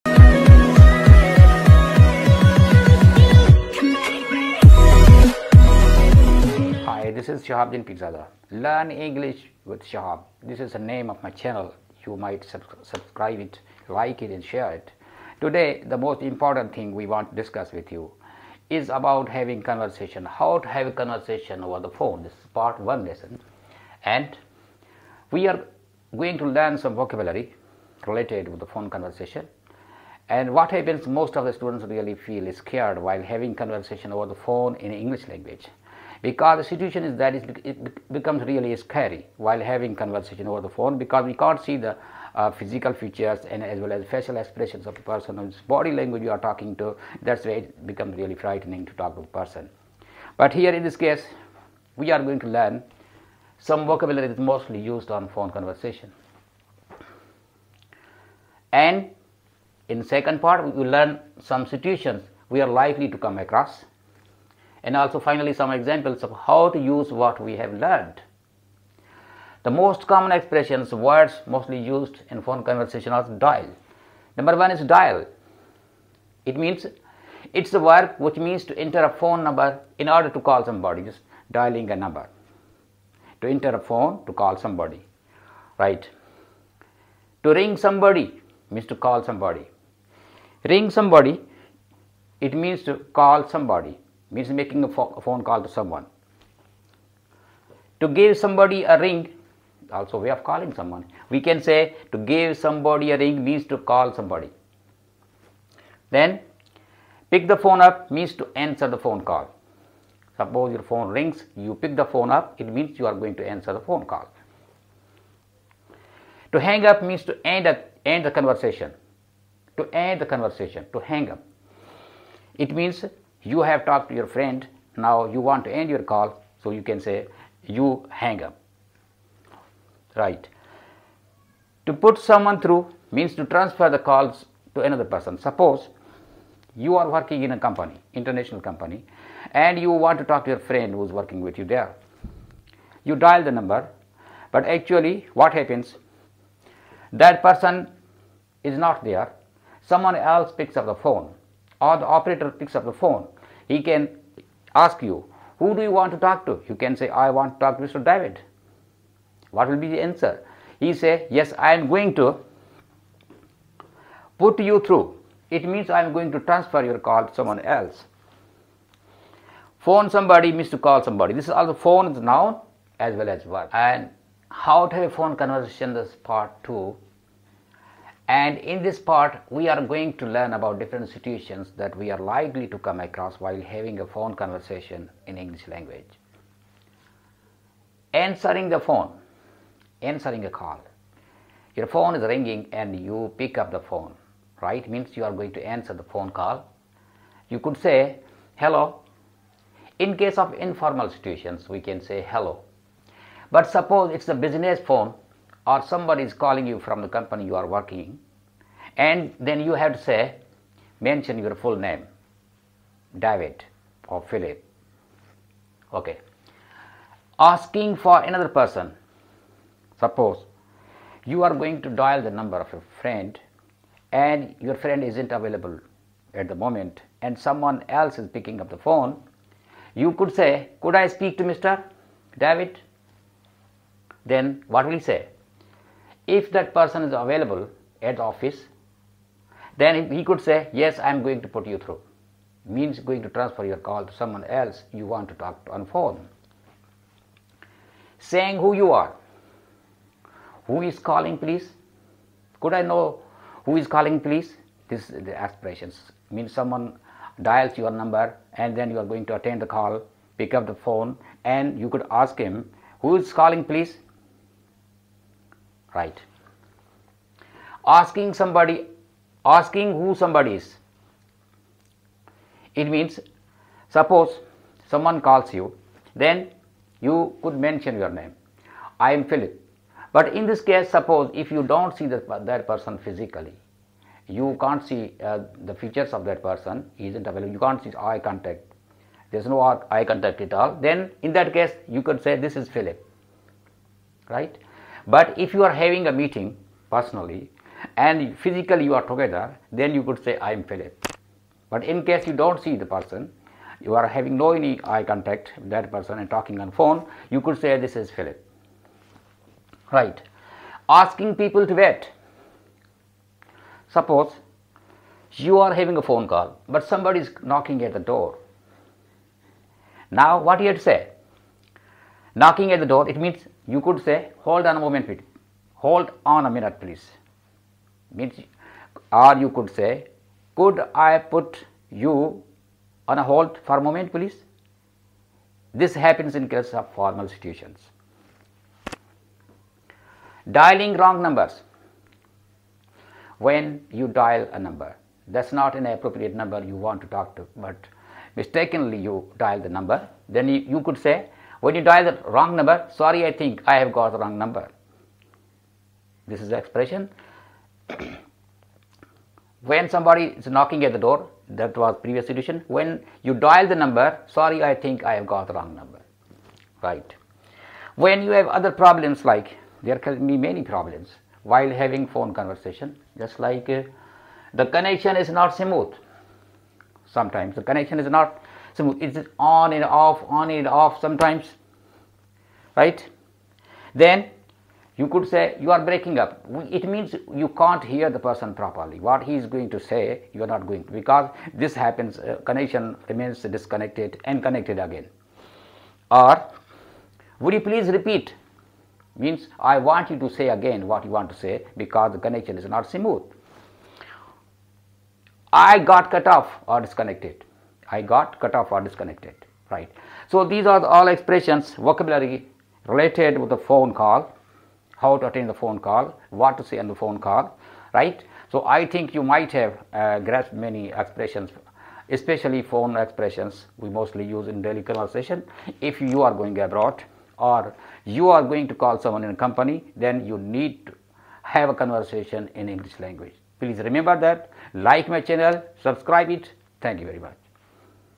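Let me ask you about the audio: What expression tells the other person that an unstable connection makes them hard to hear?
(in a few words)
You are breaking up.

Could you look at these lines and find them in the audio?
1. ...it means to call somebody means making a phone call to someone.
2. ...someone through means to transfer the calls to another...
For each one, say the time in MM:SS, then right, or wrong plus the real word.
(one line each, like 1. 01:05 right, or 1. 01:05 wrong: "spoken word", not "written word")
1. 01:32 right
2. 02:12 right.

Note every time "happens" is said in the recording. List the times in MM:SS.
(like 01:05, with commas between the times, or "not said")
00:30, 02:25, 05:35, 06:31.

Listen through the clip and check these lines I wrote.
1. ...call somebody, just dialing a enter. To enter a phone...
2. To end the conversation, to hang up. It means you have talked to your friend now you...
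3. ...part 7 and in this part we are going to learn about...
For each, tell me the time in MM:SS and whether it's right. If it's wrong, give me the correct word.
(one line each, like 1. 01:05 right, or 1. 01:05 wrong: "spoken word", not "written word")
1. 01:20 wrong: "number", not "enter"
2. 01:59 right
3. 02:56 wrong: "2", not "7".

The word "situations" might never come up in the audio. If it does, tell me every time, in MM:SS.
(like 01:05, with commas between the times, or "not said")
00:36, 01:01, 03:01, 03:21, 05:37.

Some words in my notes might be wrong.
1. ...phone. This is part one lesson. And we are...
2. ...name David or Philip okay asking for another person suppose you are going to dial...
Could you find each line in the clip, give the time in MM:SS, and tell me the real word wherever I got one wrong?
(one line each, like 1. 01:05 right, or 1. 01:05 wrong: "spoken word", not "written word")
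1. 00:21 right
2. 03:31 right.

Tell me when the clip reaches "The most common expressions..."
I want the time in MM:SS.
01:09.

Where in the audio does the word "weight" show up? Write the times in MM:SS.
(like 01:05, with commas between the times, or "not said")
not said.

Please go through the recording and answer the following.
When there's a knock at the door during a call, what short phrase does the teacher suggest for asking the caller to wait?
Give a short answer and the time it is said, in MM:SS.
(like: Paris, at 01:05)
Hold on a moment, at 05:24.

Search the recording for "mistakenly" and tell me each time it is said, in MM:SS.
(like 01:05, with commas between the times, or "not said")
05:48.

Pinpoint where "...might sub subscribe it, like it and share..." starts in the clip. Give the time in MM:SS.
00:12.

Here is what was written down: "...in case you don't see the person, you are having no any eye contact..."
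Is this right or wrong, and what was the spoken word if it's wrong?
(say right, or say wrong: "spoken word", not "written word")
right.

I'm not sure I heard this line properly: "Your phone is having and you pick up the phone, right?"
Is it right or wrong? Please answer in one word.
wrong.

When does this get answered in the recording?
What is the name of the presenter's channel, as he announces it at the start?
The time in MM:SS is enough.
00:08.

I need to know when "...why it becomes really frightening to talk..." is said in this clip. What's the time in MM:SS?
00:47.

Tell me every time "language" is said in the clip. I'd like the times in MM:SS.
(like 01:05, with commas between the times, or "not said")
00:35, 00:45, 03:05, 07:12.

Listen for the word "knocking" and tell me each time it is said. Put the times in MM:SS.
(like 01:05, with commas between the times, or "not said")
05:17, 05:22, 06:00.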